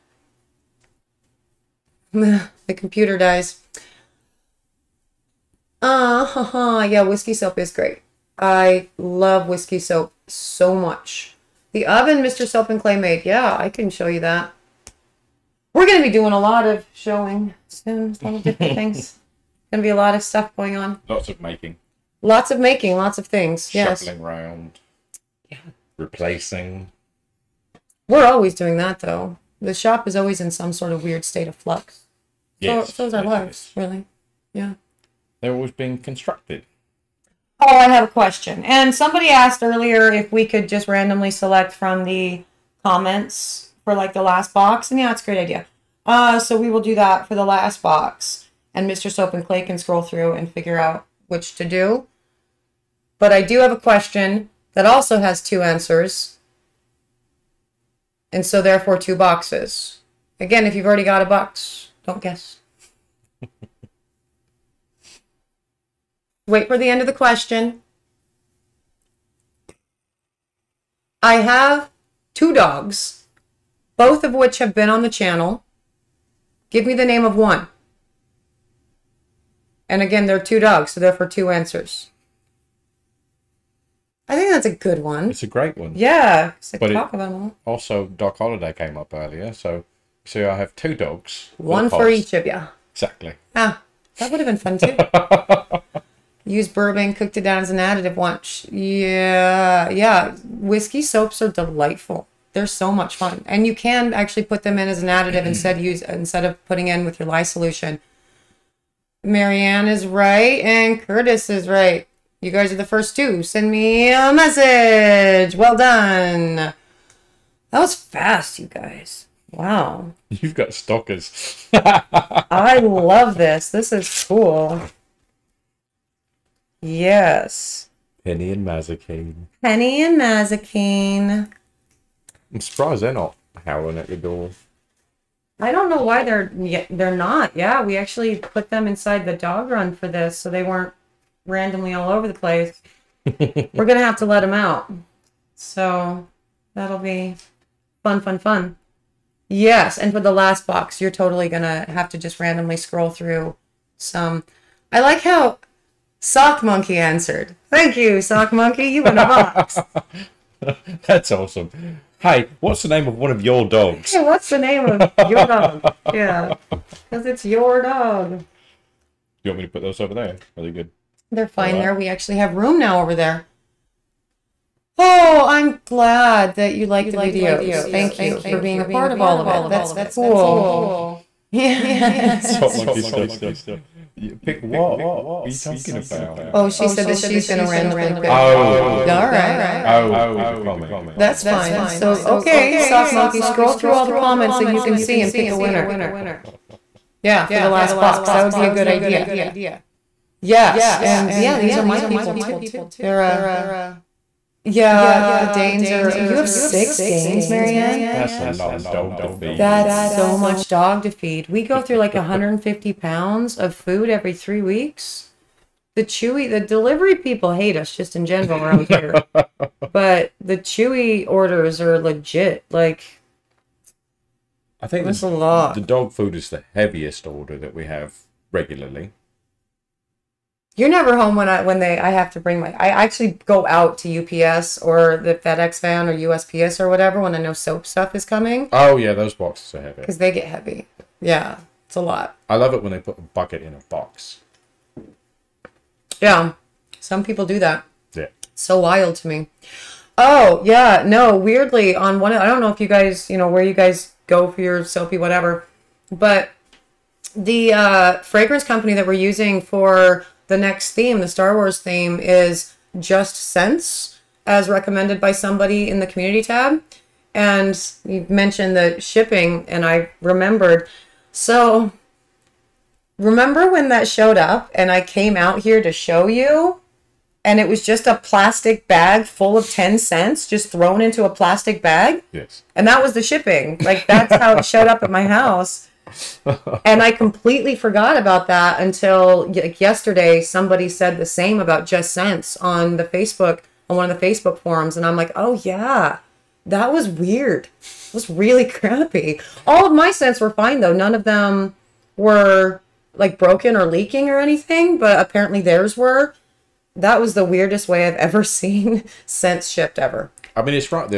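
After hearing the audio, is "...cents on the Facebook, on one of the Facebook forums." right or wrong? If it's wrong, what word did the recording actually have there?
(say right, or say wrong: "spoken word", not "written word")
right.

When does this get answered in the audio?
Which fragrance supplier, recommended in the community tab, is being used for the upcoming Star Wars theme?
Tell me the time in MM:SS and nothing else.
04:22.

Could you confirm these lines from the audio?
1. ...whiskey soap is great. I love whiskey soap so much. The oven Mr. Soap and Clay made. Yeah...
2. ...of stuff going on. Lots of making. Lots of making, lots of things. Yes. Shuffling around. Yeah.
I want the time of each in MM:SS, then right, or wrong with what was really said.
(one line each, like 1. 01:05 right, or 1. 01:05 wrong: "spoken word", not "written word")
1. 00:07 right
2. 00:20 right.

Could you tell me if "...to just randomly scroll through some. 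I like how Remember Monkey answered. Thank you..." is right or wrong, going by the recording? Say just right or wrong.
wrong.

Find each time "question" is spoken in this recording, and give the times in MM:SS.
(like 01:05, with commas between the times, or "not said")
00:38, 00:53, 01:07.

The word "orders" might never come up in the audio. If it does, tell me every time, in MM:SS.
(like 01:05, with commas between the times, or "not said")
03:41, 03:47.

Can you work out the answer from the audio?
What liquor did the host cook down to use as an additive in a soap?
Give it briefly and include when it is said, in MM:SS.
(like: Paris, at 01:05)
Bourbon, at 01:36.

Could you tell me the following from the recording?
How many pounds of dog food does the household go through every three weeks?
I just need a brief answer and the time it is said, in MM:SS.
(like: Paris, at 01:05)
150, at 03:32.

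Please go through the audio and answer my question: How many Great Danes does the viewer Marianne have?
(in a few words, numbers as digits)
6.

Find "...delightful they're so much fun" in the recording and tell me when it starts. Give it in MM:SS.
01:41.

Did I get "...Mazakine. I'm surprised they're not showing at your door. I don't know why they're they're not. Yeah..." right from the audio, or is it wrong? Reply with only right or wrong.
wrong.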